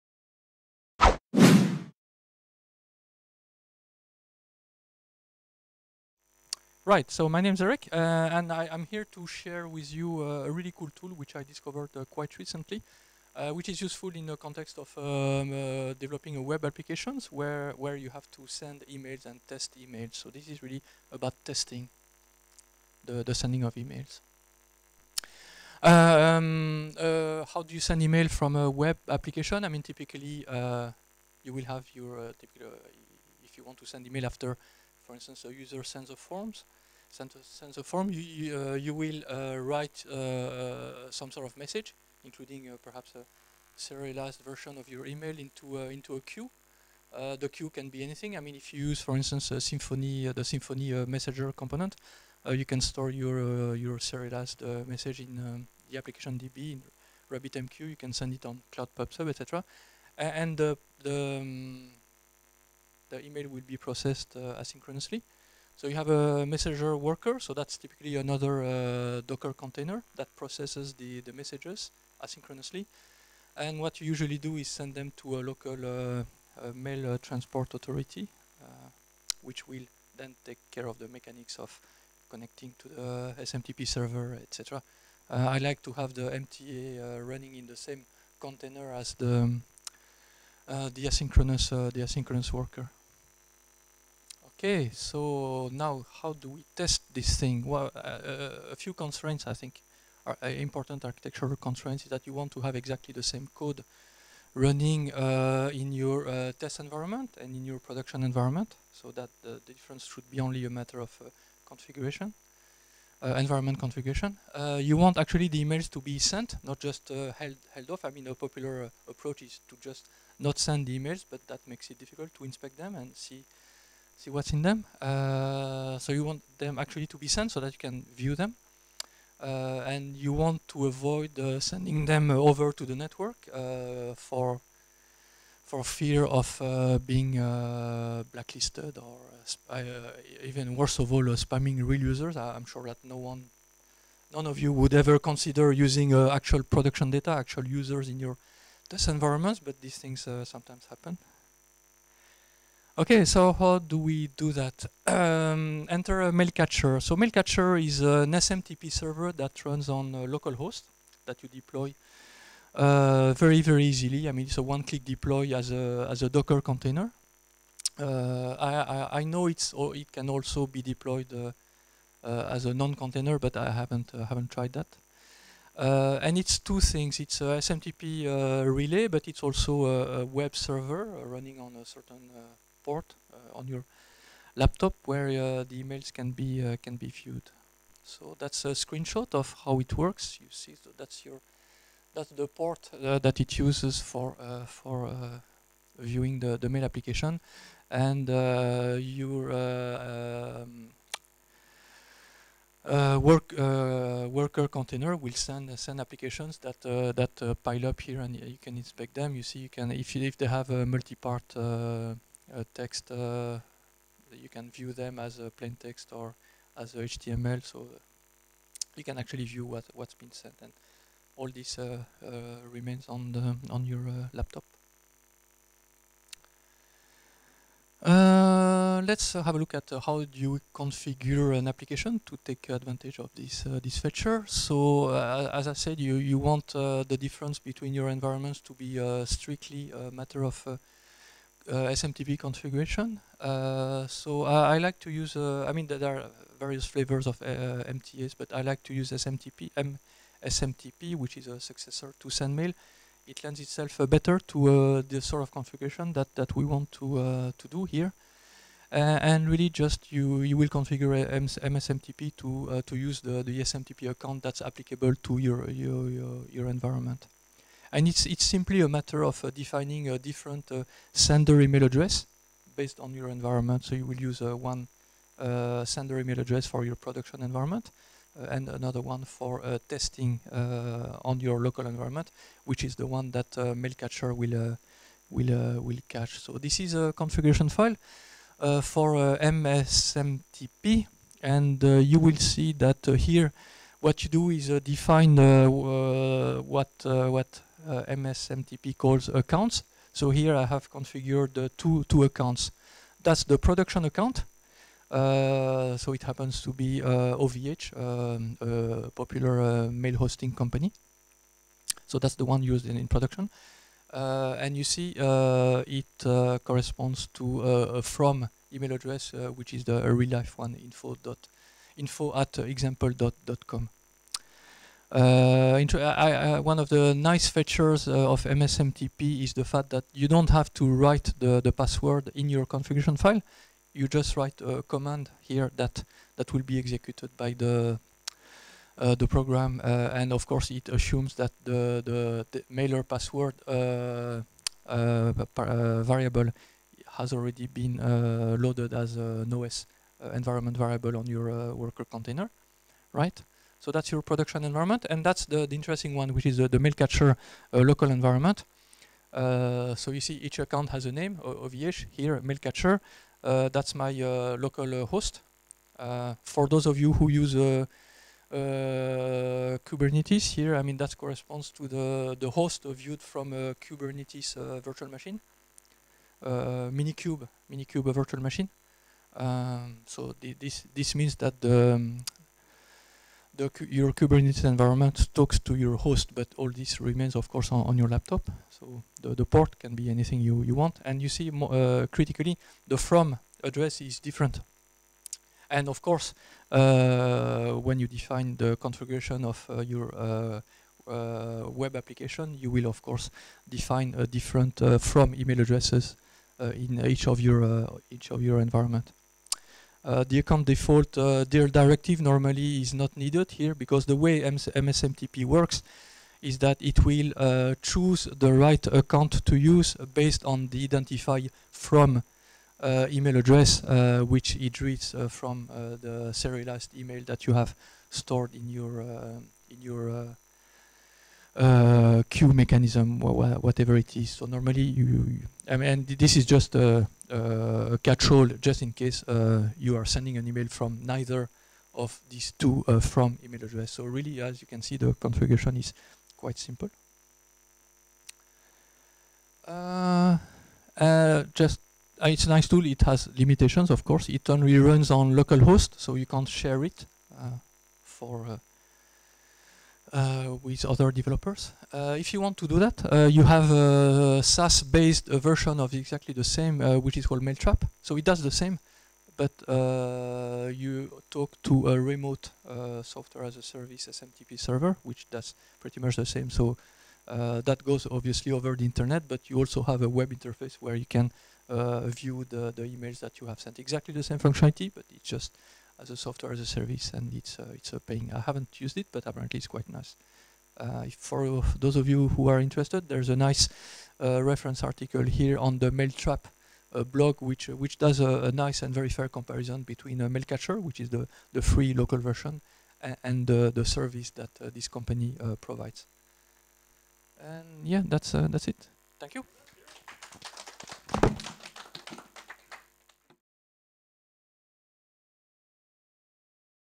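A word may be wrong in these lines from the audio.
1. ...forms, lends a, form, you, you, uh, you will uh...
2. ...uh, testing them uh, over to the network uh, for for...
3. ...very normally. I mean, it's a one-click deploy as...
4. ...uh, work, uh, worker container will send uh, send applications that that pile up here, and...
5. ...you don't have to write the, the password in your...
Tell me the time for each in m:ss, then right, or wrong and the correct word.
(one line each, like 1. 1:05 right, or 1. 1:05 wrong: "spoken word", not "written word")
1. 0:36 wrong: "sends", not "lends"
2. 2:11 wrong: "sending", not "testing"
3. 2:43 wrong: "easily", not "normally"
4. 3:22 right
5. 5:30 right.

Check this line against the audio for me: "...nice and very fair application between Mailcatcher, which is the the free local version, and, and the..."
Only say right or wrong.
wrong.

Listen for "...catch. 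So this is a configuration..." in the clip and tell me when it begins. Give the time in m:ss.
4:46.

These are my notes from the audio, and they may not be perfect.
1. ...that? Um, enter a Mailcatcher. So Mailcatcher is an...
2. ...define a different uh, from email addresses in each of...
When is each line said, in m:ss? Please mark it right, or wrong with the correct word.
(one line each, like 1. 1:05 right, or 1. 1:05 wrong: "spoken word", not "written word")
1. 2:34 right
2. 6:43 right.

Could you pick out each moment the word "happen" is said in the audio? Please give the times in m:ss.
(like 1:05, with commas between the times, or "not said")
2:30, 5:06.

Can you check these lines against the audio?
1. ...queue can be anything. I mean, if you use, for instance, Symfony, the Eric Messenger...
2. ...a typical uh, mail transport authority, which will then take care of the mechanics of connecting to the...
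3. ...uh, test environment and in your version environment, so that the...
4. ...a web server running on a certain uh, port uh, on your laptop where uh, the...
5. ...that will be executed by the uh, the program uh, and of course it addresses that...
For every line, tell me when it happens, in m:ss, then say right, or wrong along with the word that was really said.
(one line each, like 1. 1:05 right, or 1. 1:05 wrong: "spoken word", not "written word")
1. 0:47 wrong: "Symfony", not "Eric"
2. 1:15 wrong: "local", not "typical"
3. 1:46 wrong: "production", not "version"
4. 3:00 right
5. 5:36 wrong: "assumes", not "addresses".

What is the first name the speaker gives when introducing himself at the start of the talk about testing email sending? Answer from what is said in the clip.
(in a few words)
Eric.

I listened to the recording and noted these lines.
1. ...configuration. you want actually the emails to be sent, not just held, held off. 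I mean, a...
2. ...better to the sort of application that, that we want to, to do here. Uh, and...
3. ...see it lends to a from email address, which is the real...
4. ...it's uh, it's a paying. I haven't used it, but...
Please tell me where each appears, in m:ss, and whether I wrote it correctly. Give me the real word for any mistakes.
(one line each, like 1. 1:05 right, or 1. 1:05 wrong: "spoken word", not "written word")
1. 1:53 right
2. 4:14 wrong: "configuration", not "application"
3. 5:14 wrong: "corresponds", not "lends"
4. 8:07 right.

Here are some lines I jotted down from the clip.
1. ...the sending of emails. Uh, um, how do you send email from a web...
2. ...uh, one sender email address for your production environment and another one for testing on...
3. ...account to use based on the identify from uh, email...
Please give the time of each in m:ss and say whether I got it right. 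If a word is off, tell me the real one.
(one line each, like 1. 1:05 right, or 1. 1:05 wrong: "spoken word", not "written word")
1. 0:23 right
2. 4:34 right
3. 6:58 right.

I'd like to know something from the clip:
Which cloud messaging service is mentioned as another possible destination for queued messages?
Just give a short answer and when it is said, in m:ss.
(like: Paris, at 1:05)
Cloud PubSub, at 0:58.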